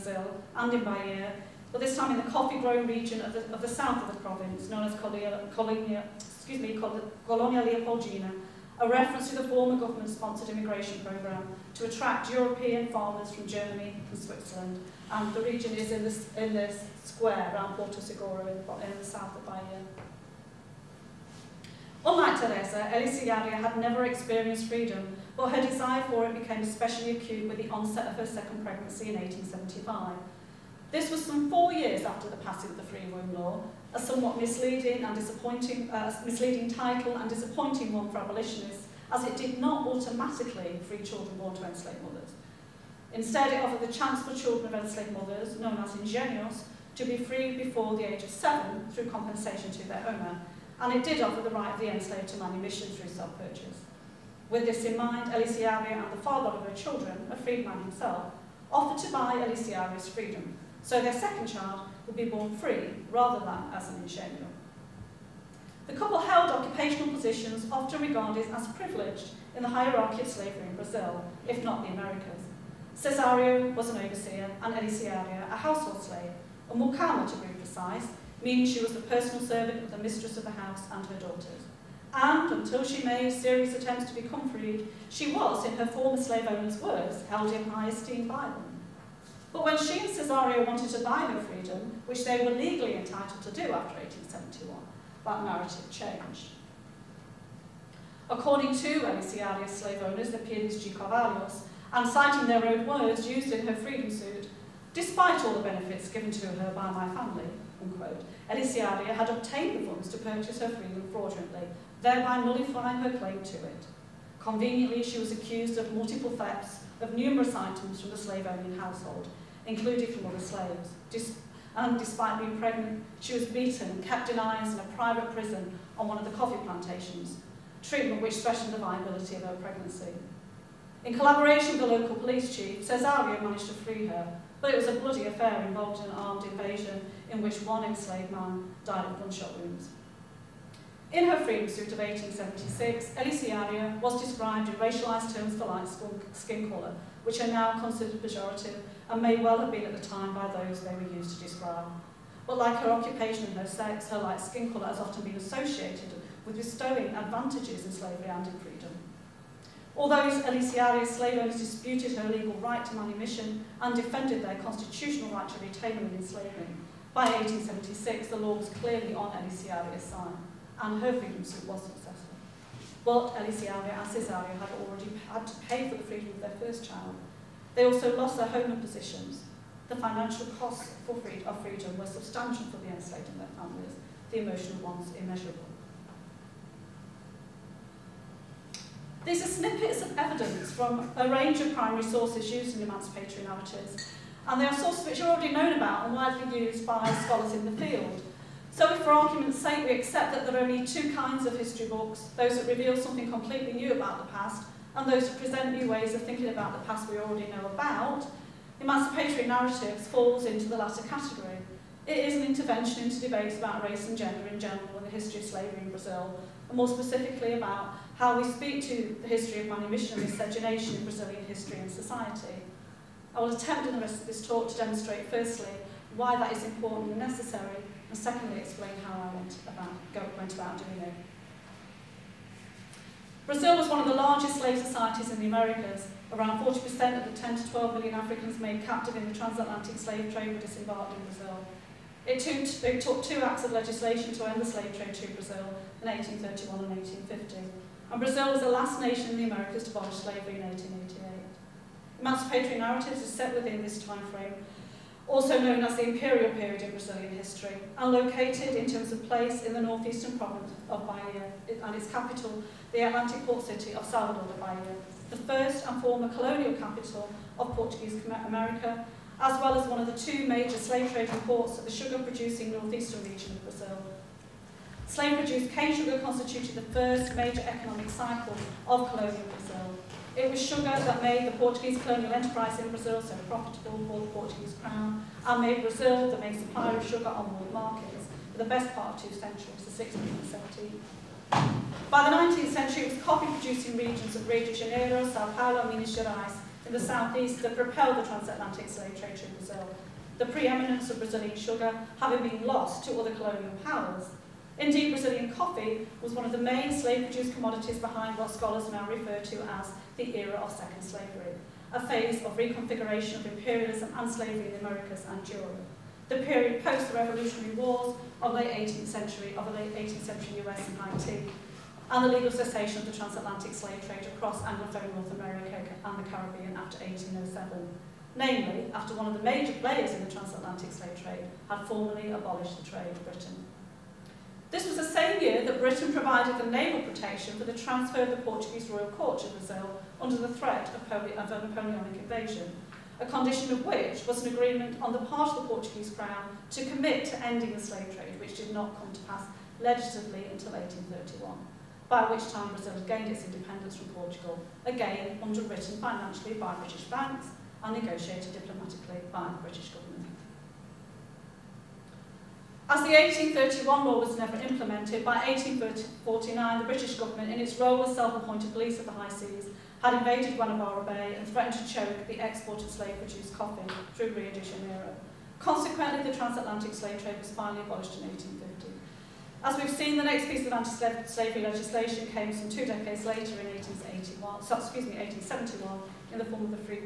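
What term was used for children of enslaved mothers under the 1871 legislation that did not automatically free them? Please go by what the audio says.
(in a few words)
ingenuos.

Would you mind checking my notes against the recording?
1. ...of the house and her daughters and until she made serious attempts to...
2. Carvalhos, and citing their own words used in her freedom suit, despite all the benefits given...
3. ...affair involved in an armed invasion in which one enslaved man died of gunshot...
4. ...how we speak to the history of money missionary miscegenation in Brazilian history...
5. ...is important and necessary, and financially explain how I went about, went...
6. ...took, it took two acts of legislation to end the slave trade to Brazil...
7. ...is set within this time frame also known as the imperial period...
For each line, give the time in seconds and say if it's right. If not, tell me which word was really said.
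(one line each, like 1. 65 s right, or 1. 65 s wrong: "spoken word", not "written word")
1. 80 s right
2. 100 s right
3. 135 s right
4. 218 s right
5. 226 s wrong: "secondly", not "financially"
6. 242 s right
7. 253 s right.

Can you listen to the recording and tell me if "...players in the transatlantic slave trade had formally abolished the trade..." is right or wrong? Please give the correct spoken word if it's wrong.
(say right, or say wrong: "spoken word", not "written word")
right.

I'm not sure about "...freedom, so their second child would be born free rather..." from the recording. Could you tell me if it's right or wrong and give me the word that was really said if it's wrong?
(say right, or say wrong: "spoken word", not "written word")
right.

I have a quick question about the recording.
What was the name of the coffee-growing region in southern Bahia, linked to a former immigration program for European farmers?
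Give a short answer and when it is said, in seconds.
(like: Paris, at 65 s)
Colonia Leopoldina, at 7 s.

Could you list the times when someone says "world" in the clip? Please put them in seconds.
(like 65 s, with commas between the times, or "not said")
287 s.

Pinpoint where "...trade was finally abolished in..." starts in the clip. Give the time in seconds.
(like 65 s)
377 s.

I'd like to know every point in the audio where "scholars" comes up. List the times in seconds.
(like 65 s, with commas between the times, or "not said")
197 s, 308 s.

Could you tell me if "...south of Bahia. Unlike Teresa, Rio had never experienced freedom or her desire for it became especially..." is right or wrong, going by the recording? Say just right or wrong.
wrong.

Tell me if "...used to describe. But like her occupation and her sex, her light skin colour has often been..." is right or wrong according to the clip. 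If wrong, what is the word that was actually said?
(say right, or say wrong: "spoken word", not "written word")
right.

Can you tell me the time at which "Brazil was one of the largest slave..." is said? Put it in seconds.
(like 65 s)
233 s.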